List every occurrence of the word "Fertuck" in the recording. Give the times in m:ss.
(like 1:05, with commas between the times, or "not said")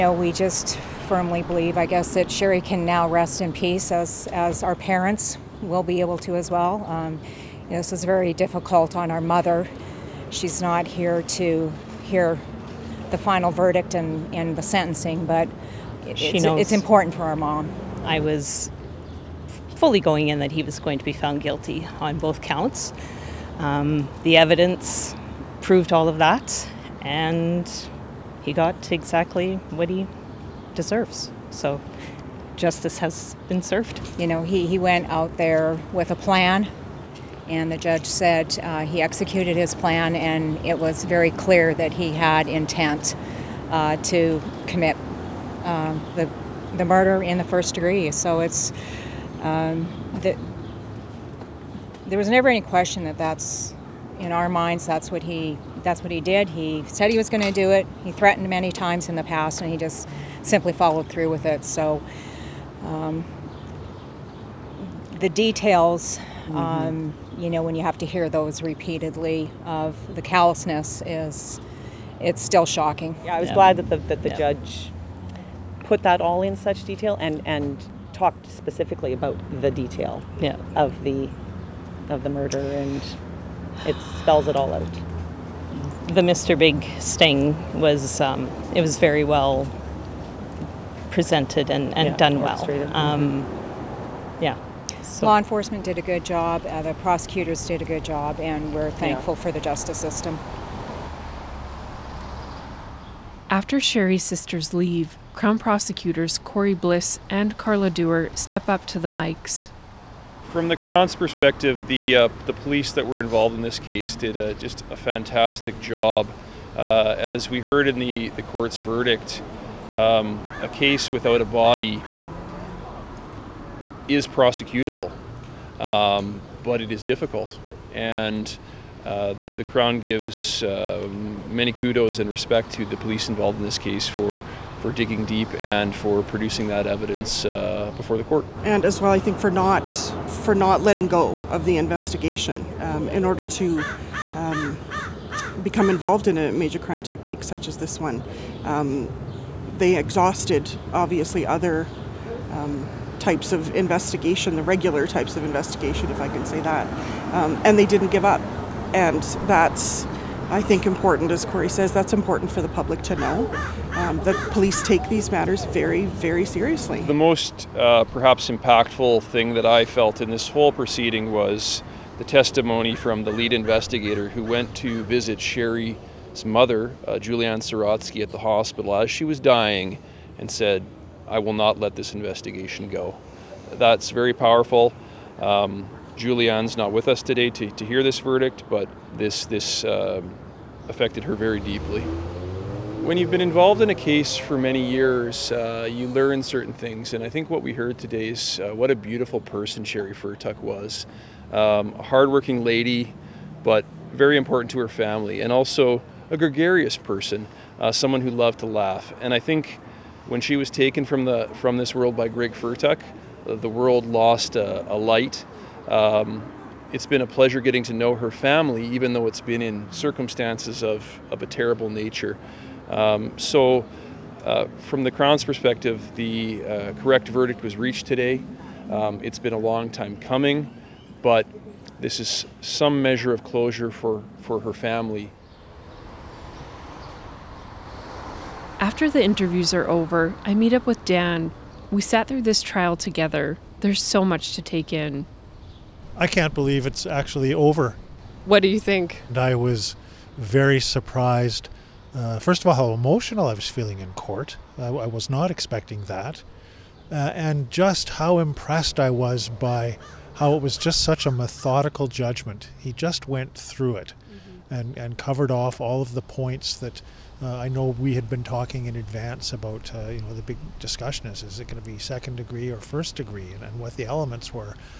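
3:20, 3:32.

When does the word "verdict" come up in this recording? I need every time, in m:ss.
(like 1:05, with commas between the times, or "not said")
0:13, 1:58, 3:08, 3:47.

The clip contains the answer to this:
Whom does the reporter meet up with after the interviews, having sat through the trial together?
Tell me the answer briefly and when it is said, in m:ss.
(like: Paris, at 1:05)
Dan, at 4:01.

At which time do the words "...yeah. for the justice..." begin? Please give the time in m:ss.
1:39.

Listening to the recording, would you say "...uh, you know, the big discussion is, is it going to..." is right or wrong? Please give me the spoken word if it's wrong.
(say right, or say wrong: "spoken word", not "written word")
right.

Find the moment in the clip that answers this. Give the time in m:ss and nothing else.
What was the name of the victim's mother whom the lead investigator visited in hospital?
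2:57.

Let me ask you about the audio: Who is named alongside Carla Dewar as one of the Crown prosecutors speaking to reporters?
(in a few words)
Corey Bliss.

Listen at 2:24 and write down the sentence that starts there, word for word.
Um, become involved in a major crime technique such as this one.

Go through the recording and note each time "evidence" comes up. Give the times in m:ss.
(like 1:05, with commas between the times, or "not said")
0:24, 2:16.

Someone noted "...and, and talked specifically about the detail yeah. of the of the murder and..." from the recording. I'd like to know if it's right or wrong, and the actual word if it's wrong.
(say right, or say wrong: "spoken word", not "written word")
right.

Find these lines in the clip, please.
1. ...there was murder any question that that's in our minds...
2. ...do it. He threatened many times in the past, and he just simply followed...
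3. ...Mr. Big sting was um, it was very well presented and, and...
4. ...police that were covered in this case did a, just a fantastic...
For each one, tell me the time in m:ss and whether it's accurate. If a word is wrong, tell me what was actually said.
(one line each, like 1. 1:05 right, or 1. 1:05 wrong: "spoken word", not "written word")
1. 0:52 wrong: "never", not "murder"
2. 0:57 right
3. 1:26 right
4. 1:52 wrong: "involved", not "covered".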